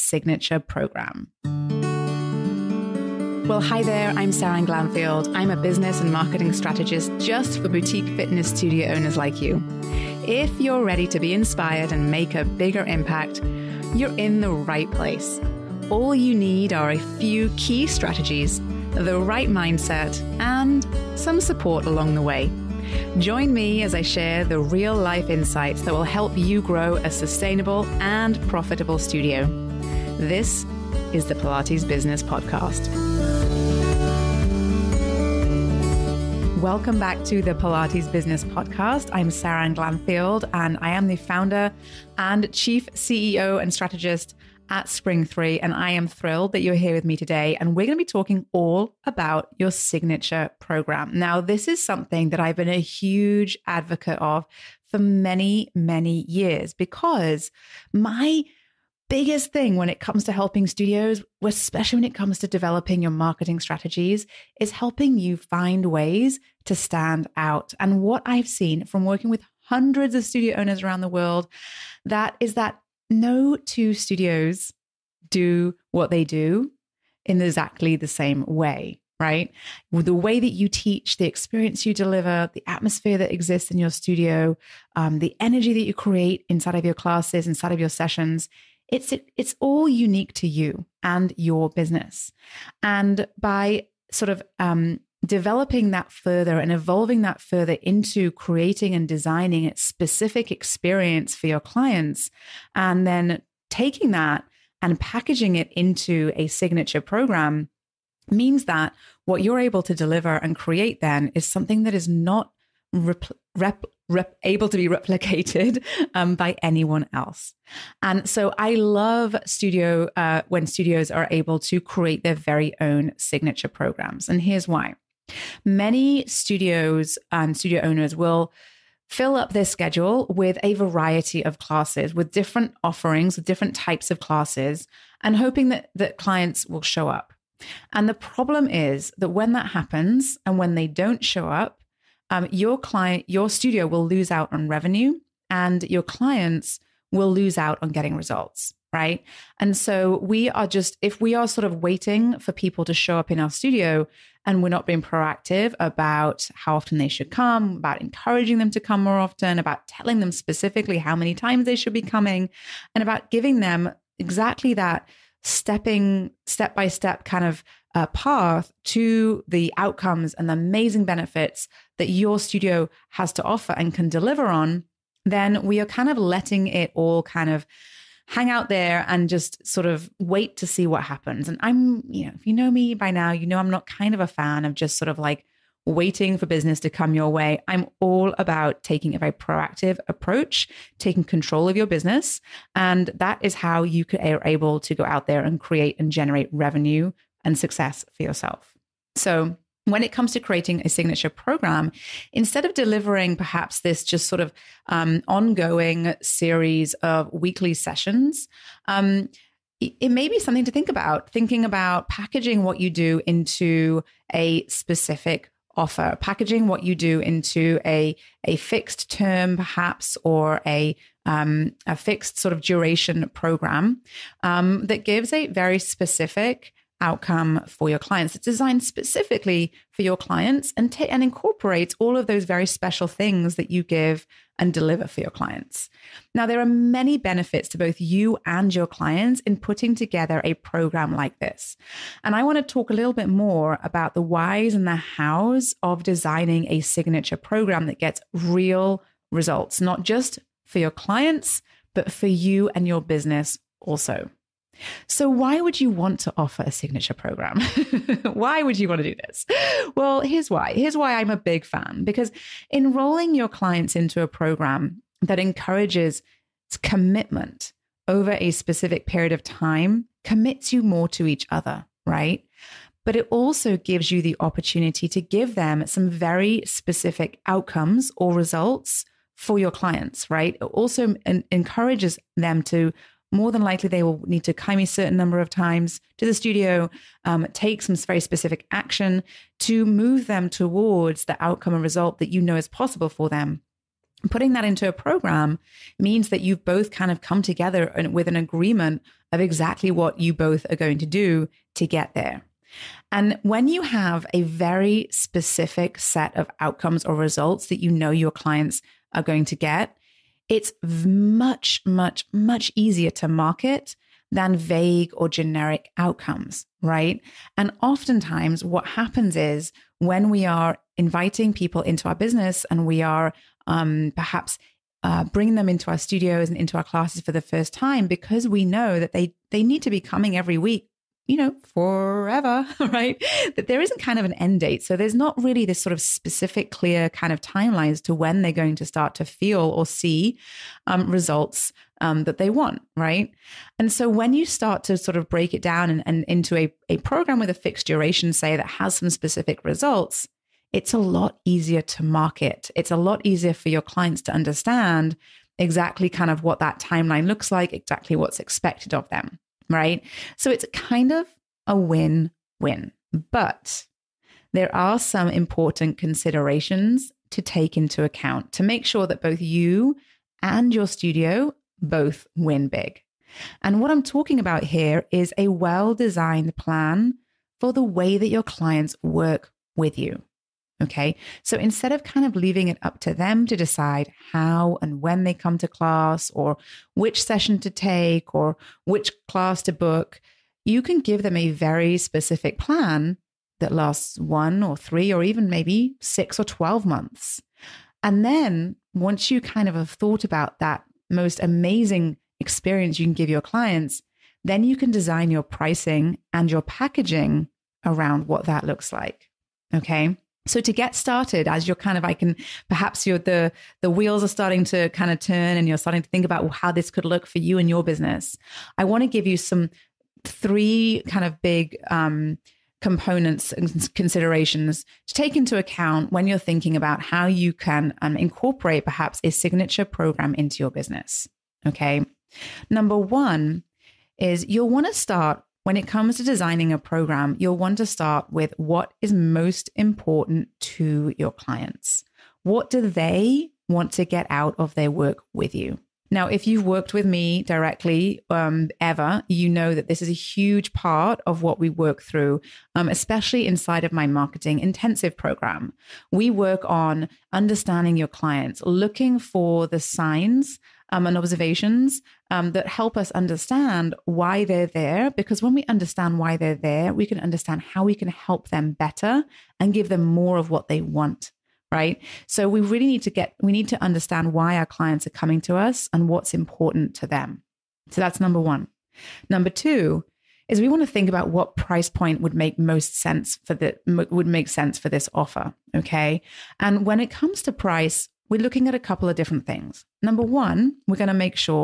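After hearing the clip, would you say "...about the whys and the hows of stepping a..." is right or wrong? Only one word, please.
wrong.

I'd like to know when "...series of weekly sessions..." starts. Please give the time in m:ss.
3:26.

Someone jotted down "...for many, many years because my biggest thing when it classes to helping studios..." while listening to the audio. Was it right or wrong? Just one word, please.
wrong.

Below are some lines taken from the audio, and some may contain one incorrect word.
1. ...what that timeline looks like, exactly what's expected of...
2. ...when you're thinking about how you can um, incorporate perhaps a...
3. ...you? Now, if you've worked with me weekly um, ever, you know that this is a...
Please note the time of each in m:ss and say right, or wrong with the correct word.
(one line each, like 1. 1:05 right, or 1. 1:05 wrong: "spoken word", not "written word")
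1. 5:56 right
2. 7:06 right
3. 7:25 wrong: "directly", not "weekly".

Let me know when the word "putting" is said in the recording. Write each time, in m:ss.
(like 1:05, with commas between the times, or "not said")
3:59, 4:54.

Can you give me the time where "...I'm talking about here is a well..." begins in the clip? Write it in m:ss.
6:13.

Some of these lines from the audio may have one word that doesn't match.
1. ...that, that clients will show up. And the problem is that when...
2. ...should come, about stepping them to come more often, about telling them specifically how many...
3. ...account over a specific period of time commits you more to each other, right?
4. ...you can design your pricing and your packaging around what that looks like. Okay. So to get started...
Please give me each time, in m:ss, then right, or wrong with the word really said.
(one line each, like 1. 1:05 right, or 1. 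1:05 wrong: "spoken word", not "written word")
1. 2:15 right
2. 2:37 wrong: "encouraging", not "stepping"
3. 4:26 wrong: "commitment", not "account"
4. 6:44 right.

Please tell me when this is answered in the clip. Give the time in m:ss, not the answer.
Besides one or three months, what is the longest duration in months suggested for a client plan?
6:36.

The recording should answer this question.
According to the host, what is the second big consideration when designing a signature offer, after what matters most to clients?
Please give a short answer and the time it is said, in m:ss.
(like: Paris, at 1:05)
price point, at 8:01.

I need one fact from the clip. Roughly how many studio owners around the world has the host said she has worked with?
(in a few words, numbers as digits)
hundreds.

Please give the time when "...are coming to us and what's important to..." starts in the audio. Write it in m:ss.
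7:55.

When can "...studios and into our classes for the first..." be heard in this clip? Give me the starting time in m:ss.
5:25.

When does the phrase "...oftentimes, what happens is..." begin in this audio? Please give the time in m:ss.
5:17.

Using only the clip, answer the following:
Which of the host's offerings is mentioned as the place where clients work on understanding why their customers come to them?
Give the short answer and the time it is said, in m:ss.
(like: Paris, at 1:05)
marketing intensive program, at 7:34.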